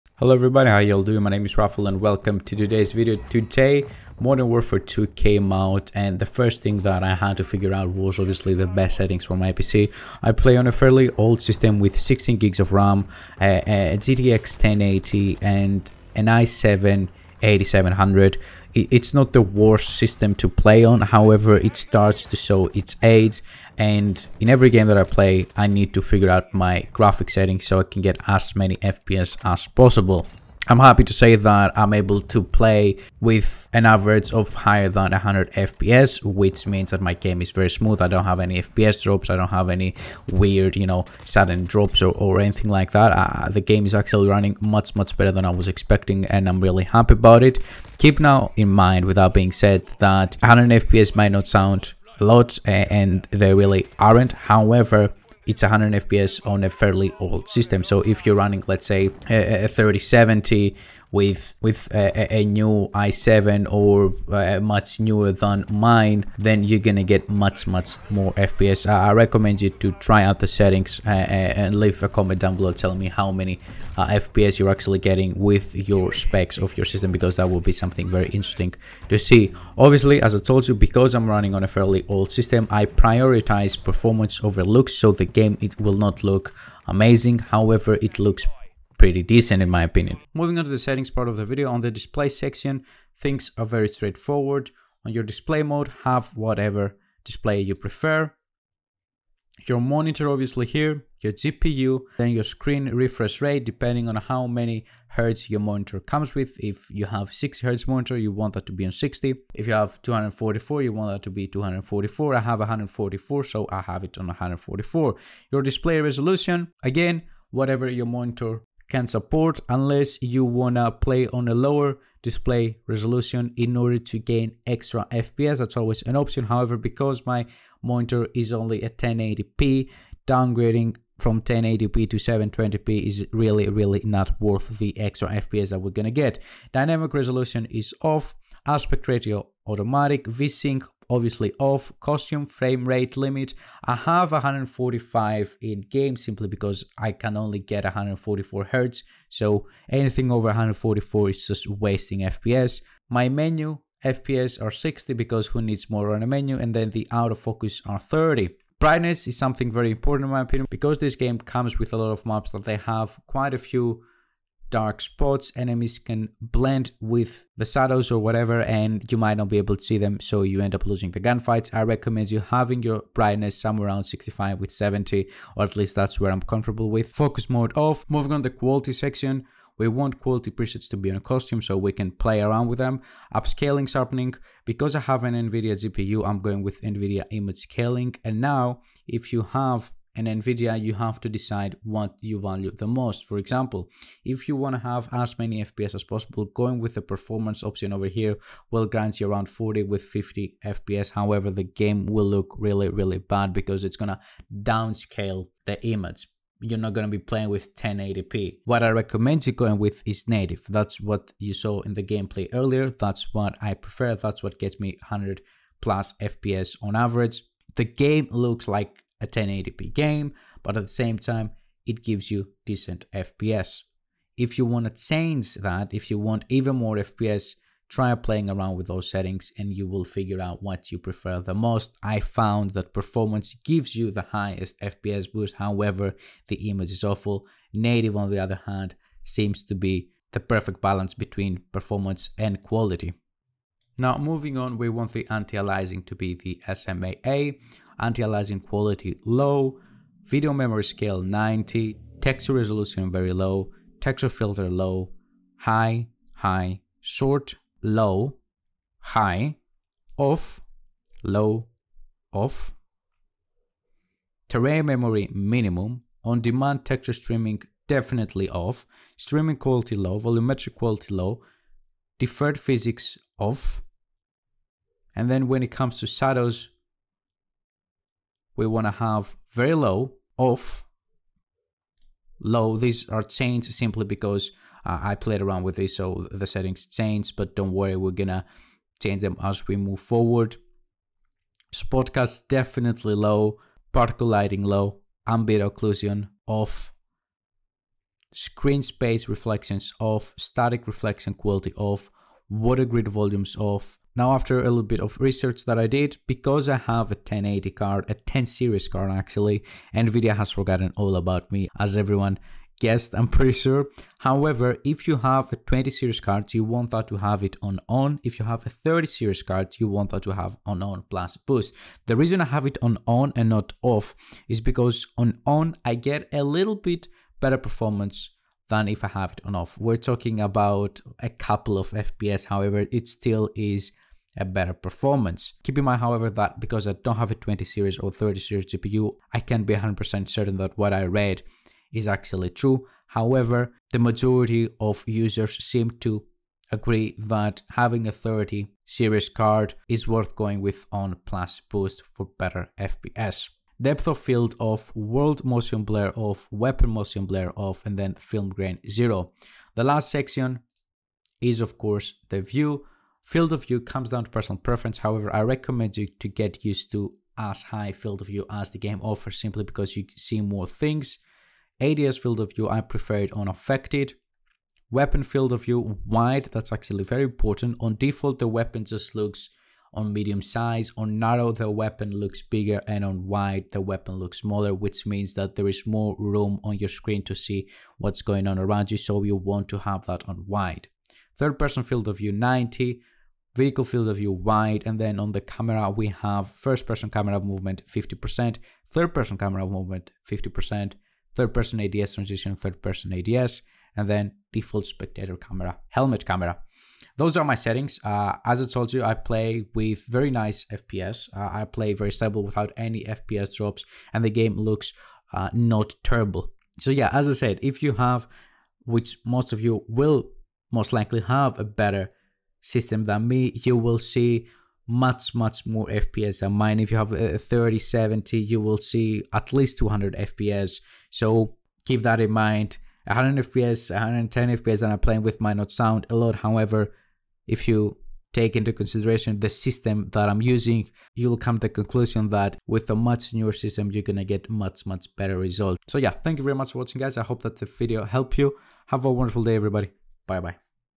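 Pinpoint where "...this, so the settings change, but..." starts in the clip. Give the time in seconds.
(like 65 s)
285 s.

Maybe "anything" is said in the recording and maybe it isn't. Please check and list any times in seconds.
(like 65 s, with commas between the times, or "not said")
42 s, 149 s.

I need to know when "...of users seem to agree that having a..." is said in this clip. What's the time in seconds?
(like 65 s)
344 s.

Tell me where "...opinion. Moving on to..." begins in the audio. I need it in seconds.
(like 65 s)
89 s.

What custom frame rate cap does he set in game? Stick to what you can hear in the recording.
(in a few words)
145.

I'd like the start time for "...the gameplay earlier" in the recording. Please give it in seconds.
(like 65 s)
211 s.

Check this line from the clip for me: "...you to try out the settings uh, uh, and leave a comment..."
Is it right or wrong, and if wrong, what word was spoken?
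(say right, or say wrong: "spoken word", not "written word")
right.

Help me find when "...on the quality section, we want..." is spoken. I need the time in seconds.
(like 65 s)
178 s.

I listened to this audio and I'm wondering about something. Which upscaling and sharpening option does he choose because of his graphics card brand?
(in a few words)
NVIDIA image scaling.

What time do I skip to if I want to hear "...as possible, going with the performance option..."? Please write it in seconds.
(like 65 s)
195 s.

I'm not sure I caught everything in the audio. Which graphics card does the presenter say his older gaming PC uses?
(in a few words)
GTX 1080.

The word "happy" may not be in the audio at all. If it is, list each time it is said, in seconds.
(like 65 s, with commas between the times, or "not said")
30 s, 46 s.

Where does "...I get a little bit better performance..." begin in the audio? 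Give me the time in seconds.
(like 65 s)
325 s.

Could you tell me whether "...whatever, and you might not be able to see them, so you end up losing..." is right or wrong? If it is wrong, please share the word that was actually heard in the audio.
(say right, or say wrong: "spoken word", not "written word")
right.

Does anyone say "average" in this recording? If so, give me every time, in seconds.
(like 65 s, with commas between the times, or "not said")
33 s, 216 s.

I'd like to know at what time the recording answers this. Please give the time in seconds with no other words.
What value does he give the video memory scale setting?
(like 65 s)
250 s.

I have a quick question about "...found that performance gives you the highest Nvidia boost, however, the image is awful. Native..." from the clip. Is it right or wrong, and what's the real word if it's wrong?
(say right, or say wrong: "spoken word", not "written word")
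wrong: "FPS", not "Nvidia".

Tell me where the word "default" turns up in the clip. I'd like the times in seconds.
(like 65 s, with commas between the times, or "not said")
377 s, 404 s.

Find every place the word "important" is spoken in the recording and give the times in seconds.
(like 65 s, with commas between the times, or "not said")
159 s, 377 s.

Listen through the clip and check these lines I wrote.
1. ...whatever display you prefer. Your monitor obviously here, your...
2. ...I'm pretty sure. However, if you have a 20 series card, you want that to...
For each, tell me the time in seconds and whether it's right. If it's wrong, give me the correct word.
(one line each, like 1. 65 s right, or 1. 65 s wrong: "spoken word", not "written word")
1. 96 s right
2. 313 s right.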